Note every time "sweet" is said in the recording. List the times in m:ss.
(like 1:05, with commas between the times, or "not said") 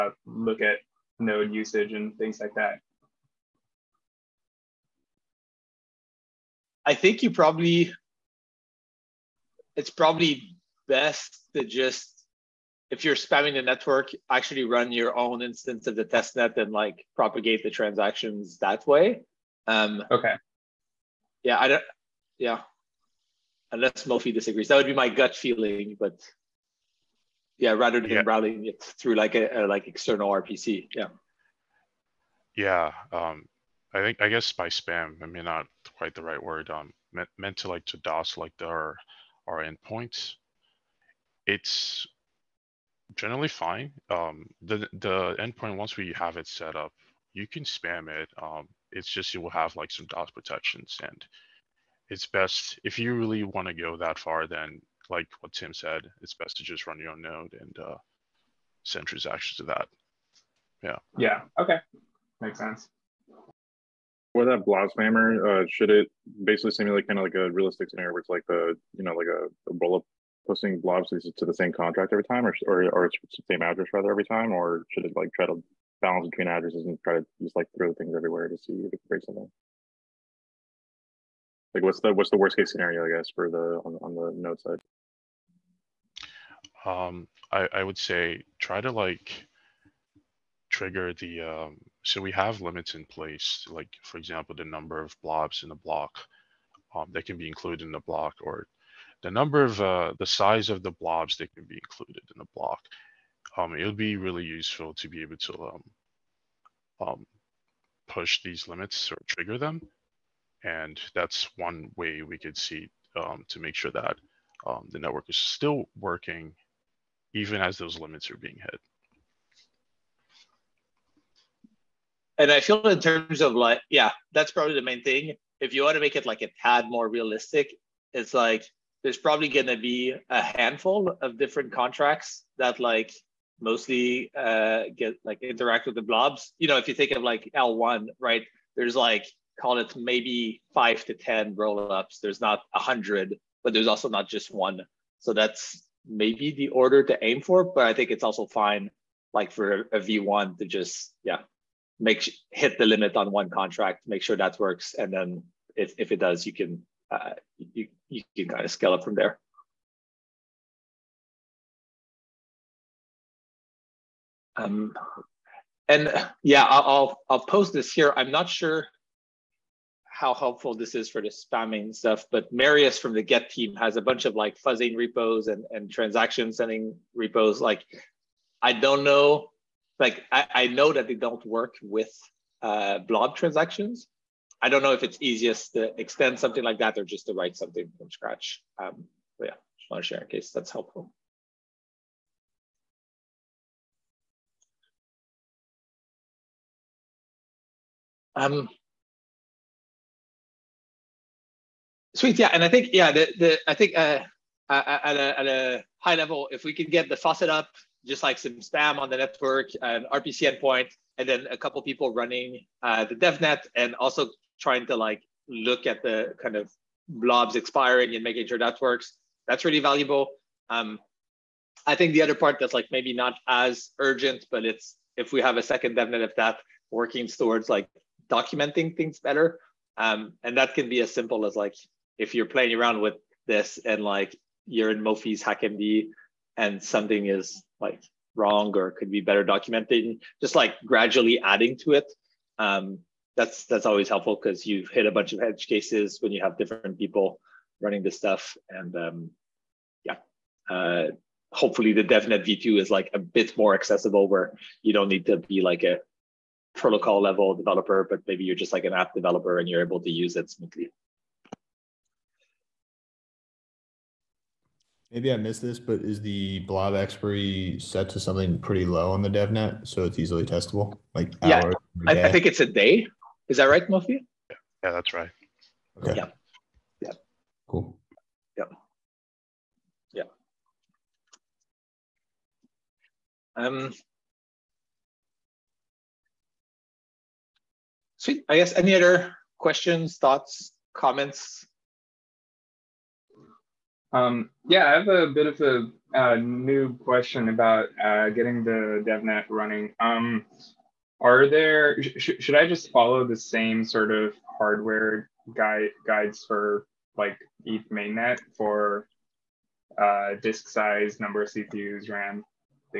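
3:22, 4:48.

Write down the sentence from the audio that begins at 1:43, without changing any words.
Um, it would be really useful to be able to um, um, push these limits or trigger them.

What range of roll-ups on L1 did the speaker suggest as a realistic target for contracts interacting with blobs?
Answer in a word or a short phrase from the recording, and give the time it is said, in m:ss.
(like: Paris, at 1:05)
5 to 10, at 2:20.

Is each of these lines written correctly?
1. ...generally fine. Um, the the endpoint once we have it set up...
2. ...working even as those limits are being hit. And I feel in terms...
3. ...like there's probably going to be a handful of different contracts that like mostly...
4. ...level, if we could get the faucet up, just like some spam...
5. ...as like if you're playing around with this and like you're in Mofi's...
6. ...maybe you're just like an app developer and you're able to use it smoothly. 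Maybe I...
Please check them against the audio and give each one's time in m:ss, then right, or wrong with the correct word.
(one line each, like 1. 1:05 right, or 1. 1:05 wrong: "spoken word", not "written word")
1. 0:43 right
2. 1:55 right
3. 2:08 right
4. 3:26 right
5. 3:51 right
6. 4:18 right.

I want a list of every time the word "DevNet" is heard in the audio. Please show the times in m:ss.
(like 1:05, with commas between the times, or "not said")
3:33, 3:45, 4:12, 4:29, 4:59.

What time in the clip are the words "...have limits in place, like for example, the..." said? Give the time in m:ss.
1:32.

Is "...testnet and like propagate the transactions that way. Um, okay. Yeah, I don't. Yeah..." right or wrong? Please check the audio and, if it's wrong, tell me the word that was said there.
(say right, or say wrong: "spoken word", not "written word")
right.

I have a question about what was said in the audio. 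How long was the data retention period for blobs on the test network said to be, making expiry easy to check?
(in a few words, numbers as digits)
1 day.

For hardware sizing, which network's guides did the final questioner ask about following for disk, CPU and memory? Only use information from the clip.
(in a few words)
ETH mainnet.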